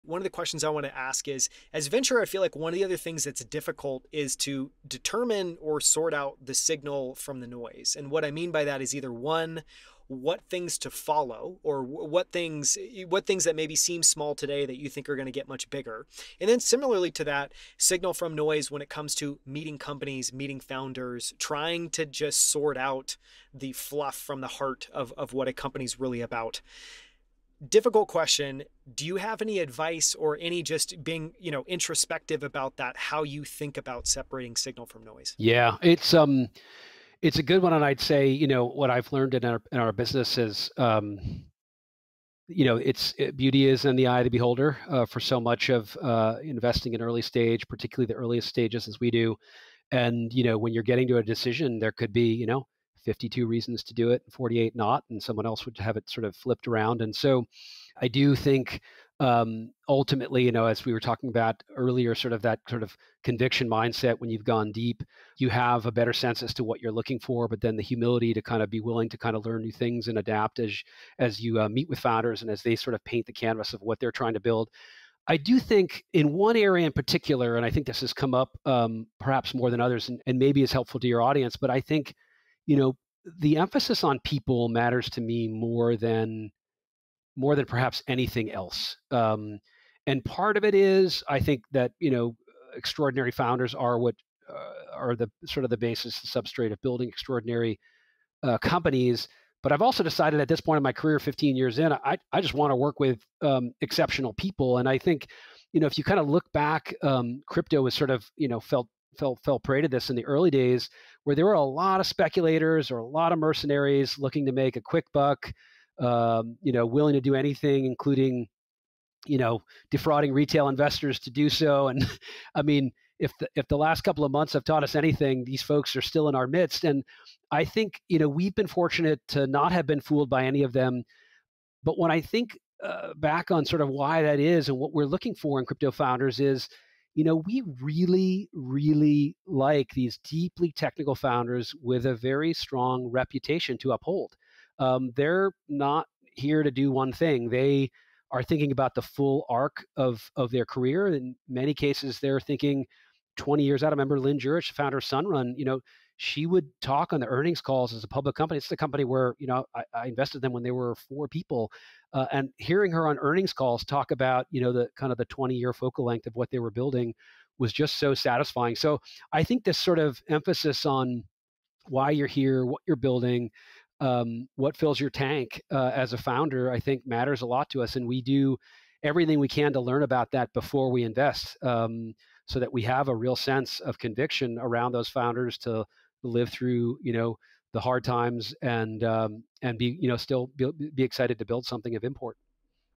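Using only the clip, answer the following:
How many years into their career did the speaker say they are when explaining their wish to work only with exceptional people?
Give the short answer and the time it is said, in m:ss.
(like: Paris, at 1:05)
15 years, at 1:41.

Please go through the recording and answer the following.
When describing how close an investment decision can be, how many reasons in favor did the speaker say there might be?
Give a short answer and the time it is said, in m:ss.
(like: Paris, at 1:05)
52, at 0:53.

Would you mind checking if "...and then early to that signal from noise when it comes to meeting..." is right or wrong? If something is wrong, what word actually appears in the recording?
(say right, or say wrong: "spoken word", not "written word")
wrong: "similarly", not "early".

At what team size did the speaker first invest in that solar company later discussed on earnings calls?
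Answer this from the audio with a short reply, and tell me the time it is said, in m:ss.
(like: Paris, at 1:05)
4 people, at 2:40.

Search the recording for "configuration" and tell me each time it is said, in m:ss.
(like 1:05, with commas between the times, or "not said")
not said.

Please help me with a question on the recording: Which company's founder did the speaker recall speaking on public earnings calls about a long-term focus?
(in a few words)
Sunrun.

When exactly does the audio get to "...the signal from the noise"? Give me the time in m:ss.
0:06.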